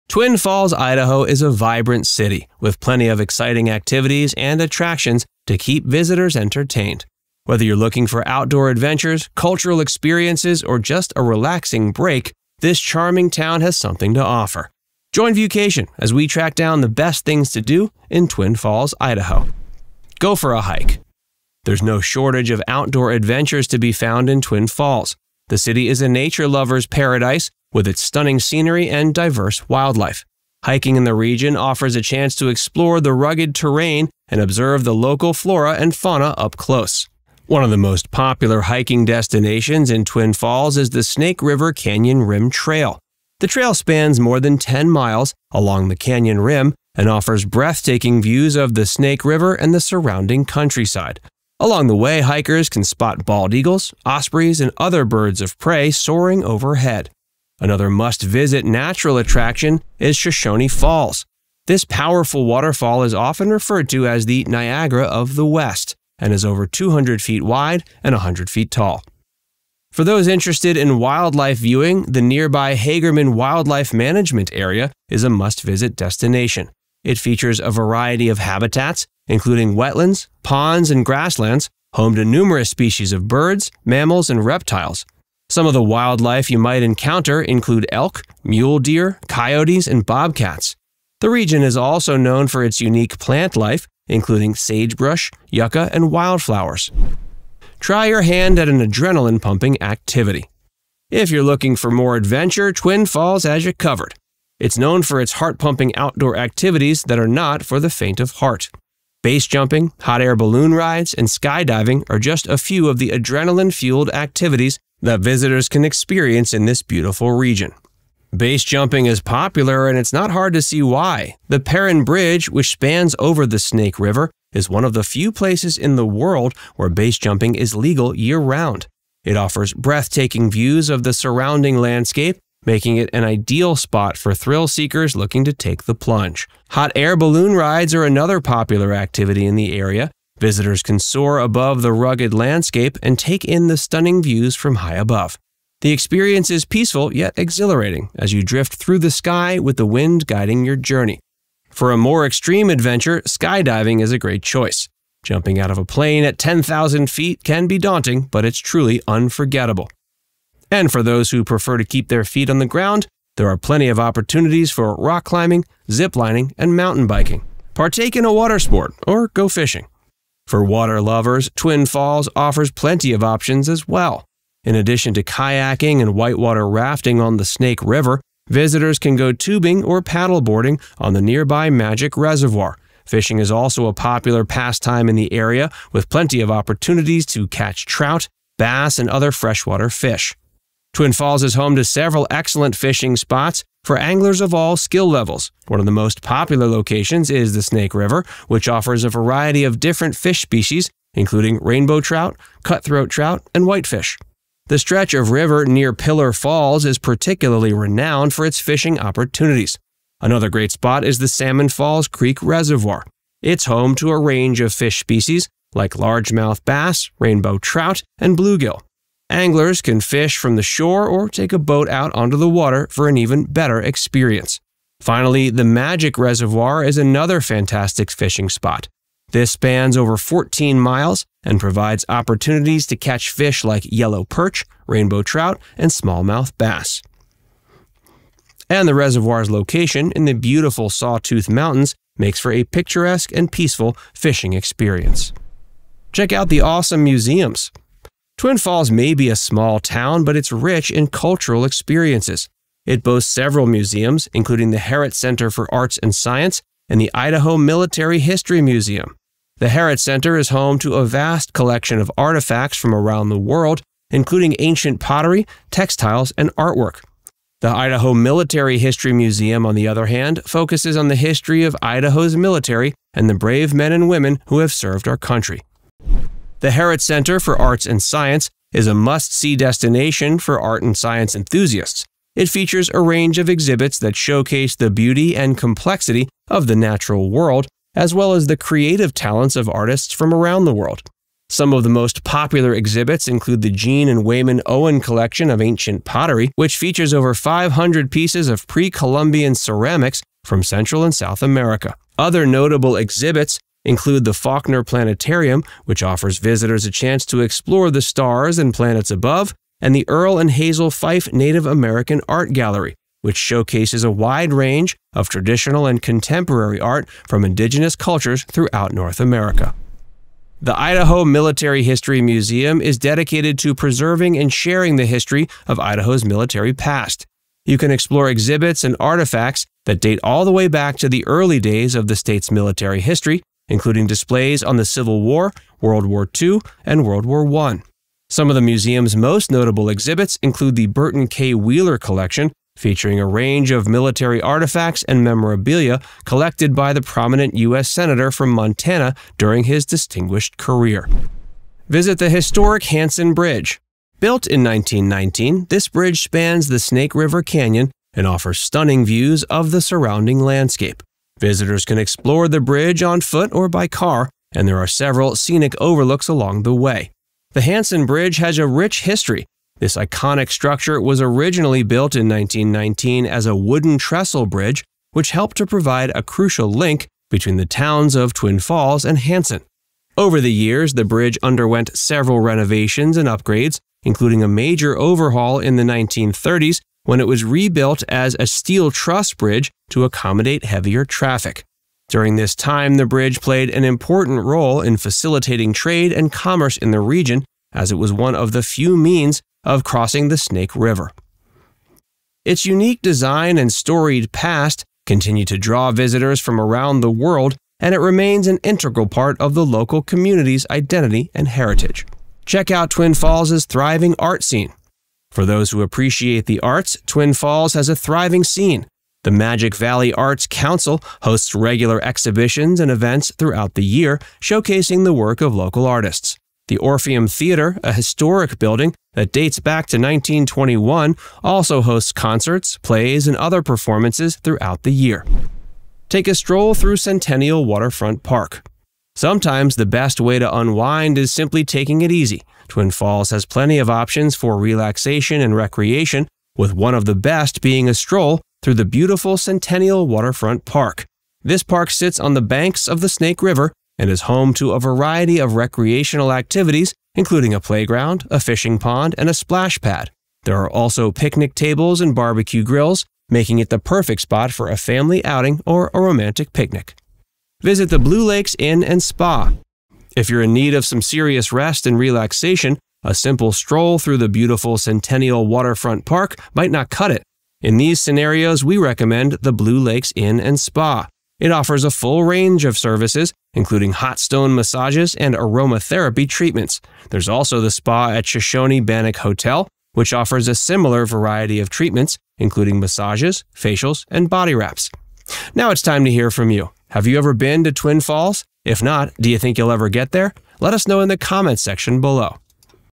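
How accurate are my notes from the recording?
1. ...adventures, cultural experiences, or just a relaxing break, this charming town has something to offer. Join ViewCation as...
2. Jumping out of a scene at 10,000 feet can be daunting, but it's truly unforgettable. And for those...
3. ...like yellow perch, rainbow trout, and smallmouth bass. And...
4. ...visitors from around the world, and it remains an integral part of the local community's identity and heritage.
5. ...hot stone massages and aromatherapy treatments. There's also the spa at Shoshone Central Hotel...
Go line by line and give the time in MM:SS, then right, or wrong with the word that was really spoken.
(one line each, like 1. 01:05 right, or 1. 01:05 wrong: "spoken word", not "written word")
1. 00:08 right
2. 02:35 wrong: "plane", not "scene"
3. 03:53 right
4. 06:45 right
5. 08:03 wrong: "Bannock", not "Central".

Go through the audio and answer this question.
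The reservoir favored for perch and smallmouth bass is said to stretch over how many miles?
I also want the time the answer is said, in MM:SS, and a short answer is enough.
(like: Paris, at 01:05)
14 miles, at 03:50.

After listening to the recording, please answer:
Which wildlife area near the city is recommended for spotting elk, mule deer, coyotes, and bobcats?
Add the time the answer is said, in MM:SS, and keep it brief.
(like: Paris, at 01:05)
Hagerman Wildlife Management Area, at 01:12.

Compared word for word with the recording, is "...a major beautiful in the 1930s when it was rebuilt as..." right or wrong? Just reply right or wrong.
wrong.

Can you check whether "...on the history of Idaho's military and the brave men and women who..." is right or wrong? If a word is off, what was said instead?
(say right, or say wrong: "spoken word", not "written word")
right.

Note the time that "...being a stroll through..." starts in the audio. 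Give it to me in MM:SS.
07:27.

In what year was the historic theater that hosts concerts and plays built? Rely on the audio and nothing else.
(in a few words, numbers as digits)
1921.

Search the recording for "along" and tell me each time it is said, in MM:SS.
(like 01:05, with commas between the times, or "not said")
00:45, 00:51, 06:06.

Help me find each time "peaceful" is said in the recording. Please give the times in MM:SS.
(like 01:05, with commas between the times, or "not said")
02:26, 04:03.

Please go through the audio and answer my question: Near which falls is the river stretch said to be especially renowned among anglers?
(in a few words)
Pillar Falls.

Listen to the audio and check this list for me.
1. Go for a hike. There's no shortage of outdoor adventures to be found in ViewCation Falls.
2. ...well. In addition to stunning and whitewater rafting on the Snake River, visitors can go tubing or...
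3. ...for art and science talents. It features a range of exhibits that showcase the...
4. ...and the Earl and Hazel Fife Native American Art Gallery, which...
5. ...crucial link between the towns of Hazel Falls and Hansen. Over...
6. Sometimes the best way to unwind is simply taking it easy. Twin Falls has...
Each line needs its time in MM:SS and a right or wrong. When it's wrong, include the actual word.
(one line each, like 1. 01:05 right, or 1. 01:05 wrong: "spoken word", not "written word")
1. 00:20 wrong: "Twin", not "ViewCation"
2. 02:53 wrong: "kayaking", not "stunning"
3. 04:40 wrong: "enthusiasts", not "talents"
4. 05:09 right
5. 06:16 wrong: "Twin", not "Hazel"
6. 07:19 right.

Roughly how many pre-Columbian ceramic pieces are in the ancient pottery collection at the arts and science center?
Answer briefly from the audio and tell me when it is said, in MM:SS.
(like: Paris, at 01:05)
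over 500, at 04:57.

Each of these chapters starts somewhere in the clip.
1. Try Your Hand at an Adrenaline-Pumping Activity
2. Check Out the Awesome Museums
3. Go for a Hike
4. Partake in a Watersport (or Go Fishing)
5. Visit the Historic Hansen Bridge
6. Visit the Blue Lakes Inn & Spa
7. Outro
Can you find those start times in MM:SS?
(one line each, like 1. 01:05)
1. 01:37
2. 04:06
3. 00:20
4. 02:47
5. 05:51
6. 07:47
7. 08:15.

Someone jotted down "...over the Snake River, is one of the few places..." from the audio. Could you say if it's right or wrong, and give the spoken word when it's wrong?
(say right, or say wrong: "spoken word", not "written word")
right.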